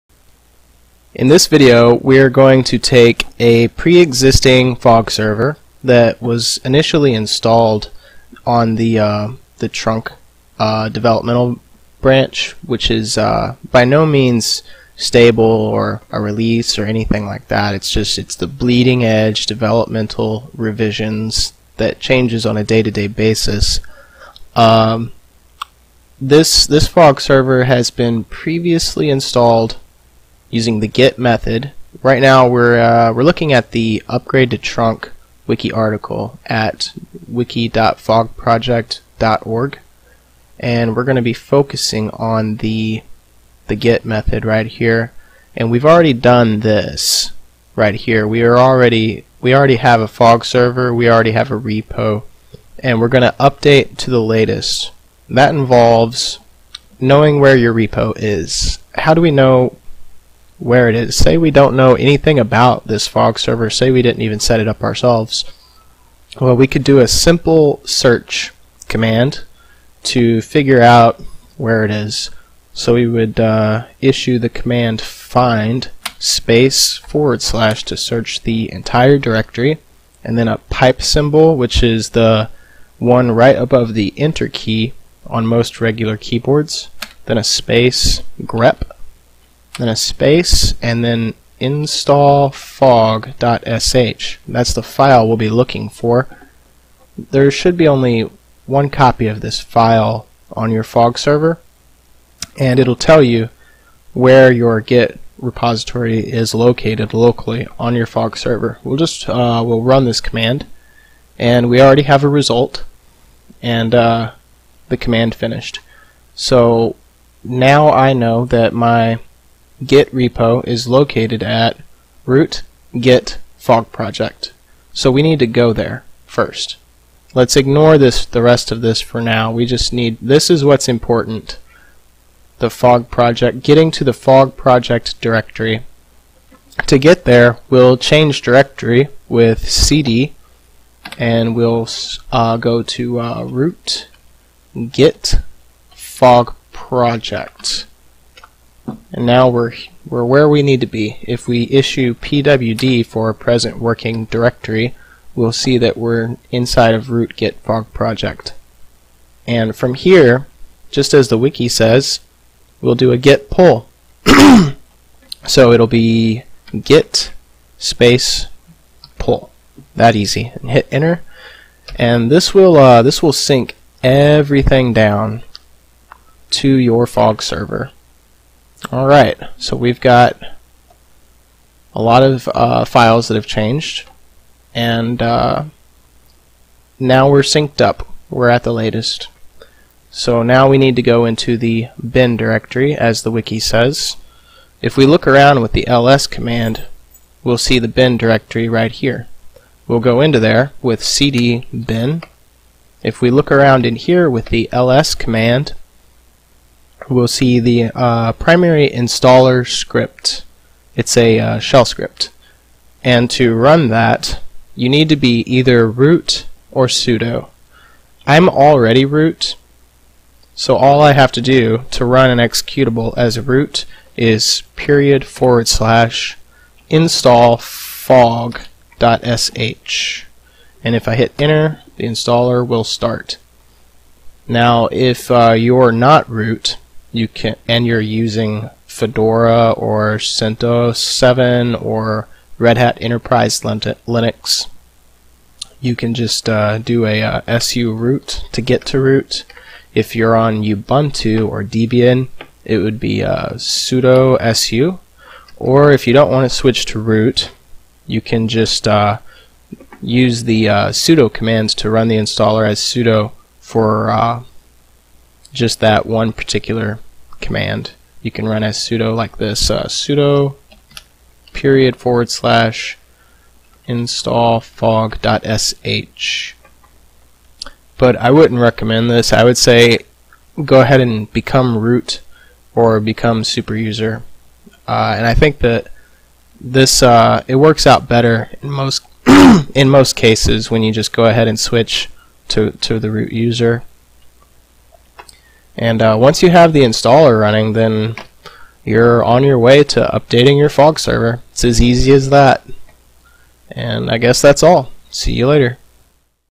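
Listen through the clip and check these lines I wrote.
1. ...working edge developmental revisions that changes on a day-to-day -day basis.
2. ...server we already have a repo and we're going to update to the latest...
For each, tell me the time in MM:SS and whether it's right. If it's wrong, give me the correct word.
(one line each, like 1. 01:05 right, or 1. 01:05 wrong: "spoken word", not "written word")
1. 00:18 wrong: "bleeding", not "working"
2. 00:50 right.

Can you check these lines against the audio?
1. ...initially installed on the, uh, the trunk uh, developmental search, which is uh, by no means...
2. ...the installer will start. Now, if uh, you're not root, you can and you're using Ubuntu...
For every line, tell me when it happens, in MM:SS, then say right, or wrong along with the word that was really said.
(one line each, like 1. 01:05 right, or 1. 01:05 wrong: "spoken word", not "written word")
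1. 00:06 wrong: "branch", not "search"
2. 03:51 wrong: "Fedora", not "Ubuntu".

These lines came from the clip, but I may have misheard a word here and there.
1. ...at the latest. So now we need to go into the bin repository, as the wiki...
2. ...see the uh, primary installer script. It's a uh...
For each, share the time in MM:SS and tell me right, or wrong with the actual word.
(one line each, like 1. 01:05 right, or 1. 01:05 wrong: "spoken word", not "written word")
1. 03:08 wrong: "directory", not "repository"
2. 03:27 right.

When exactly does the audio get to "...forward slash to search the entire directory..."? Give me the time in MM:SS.
01:16.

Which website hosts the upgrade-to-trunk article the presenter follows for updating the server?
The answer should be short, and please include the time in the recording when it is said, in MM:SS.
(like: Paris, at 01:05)
wiki.fogproject.org, at 00:37.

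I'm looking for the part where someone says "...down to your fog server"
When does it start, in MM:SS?
02:54.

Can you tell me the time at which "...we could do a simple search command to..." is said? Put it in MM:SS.
01:06.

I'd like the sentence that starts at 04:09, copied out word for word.
If you're on Ubuntu or Debian, it would be uh, sudo su.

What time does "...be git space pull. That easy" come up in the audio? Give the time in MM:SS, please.
02:45.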